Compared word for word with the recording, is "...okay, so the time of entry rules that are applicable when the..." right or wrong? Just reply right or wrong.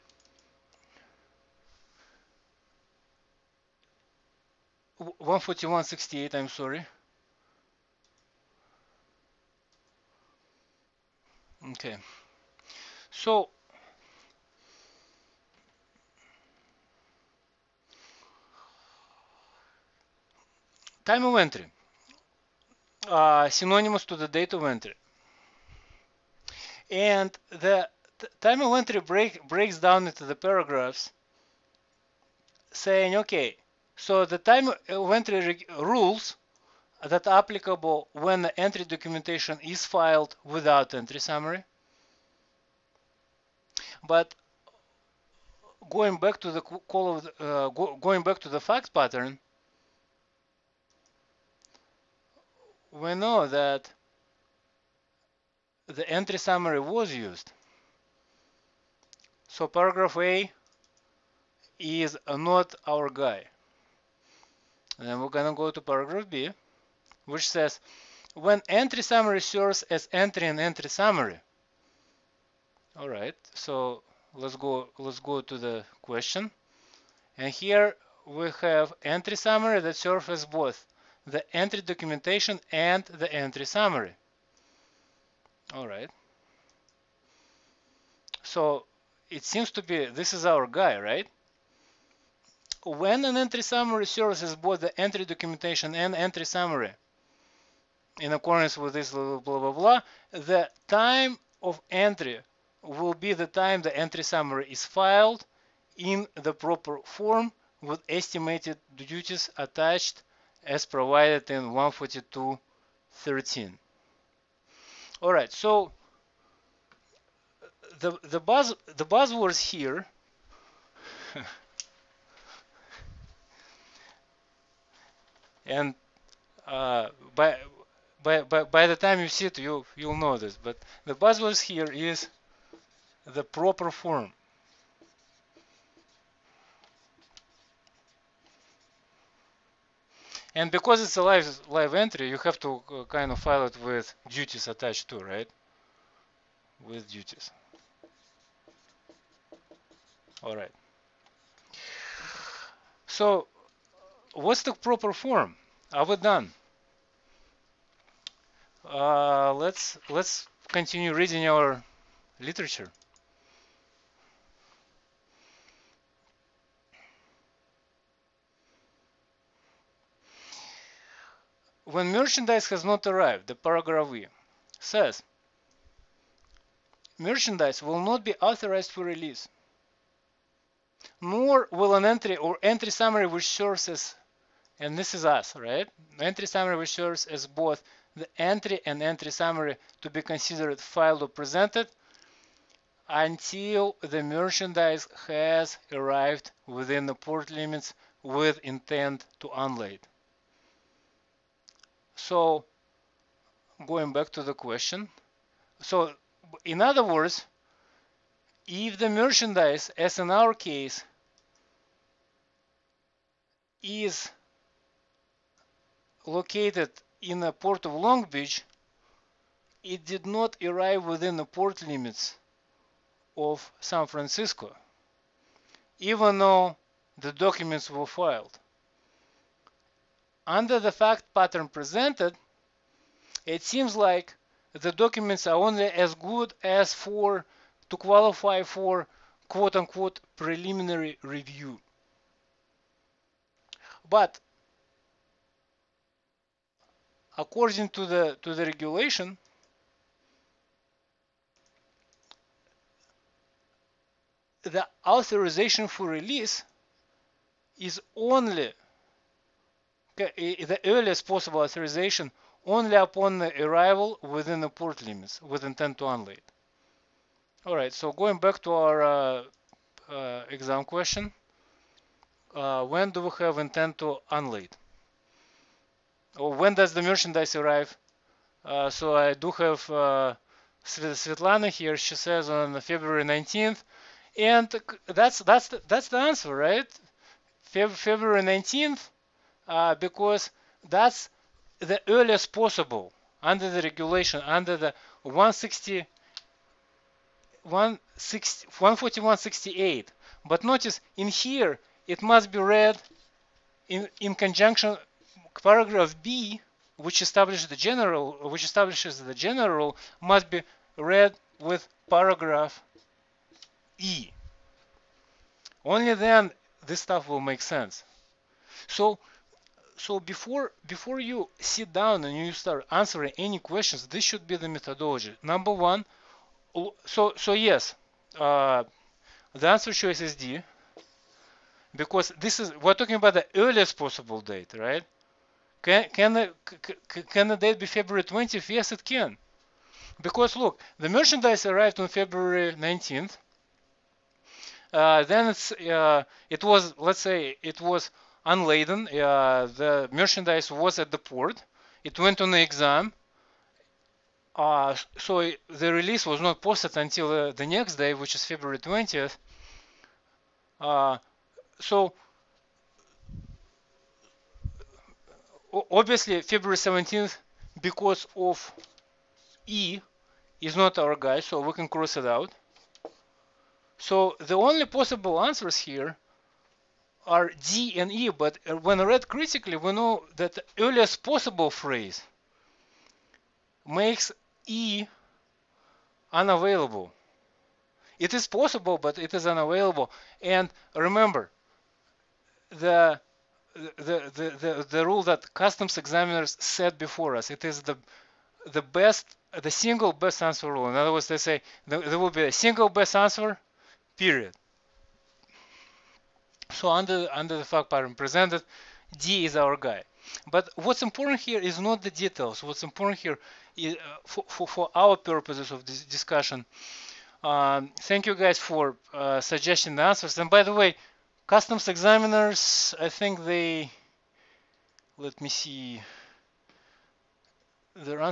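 right.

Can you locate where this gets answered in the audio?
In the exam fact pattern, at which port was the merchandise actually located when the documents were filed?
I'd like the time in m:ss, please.
3:37.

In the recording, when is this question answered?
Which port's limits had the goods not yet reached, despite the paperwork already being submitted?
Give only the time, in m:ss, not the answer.
3:43.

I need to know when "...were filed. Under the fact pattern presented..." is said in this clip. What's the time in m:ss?
3:47.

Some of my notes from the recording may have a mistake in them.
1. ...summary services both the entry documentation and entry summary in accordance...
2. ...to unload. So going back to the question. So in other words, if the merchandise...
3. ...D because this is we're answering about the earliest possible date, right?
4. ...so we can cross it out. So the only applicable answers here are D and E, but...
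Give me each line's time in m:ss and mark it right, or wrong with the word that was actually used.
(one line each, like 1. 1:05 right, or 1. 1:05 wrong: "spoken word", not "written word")
1. 1:33 right
2. 3:19 right
3. 5:30 wrong: "talking", not "answering"
4. 6:11 wrong: "possible", not "applicable".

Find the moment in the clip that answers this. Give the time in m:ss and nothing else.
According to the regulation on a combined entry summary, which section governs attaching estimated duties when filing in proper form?
1:51.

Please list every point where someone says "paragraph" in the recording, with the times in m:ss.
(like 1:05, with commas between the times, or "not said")
0:30, 0:59, 1:05, 2:53, 5:05, 5:12.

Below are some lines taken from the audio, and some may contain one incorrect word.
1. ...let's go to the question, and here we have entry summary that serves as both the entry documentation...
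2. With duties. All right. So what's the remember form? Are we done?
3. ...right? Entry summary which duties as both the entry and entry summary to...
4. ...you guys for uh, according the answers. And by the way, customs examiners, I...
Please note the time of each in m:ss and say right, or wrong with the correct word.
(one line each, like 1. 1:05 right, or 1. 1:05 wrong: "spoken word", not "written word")
1. 1:14 right
2. 2:26 wrong: "proper", not "remember"
3. 3:05 wrong: "serves", not "duties"
4. 6:58 wrong: "suggesting", not "according".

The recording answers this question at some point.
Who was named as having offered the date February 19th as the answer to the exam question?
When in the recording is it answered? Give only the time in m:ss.
4:40.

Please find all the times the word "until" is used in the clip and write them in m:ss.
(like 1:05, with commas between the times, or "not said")
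3:13, 5:56.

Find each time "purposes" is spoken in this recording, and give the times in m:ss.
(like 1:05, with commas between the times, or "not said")
6:55.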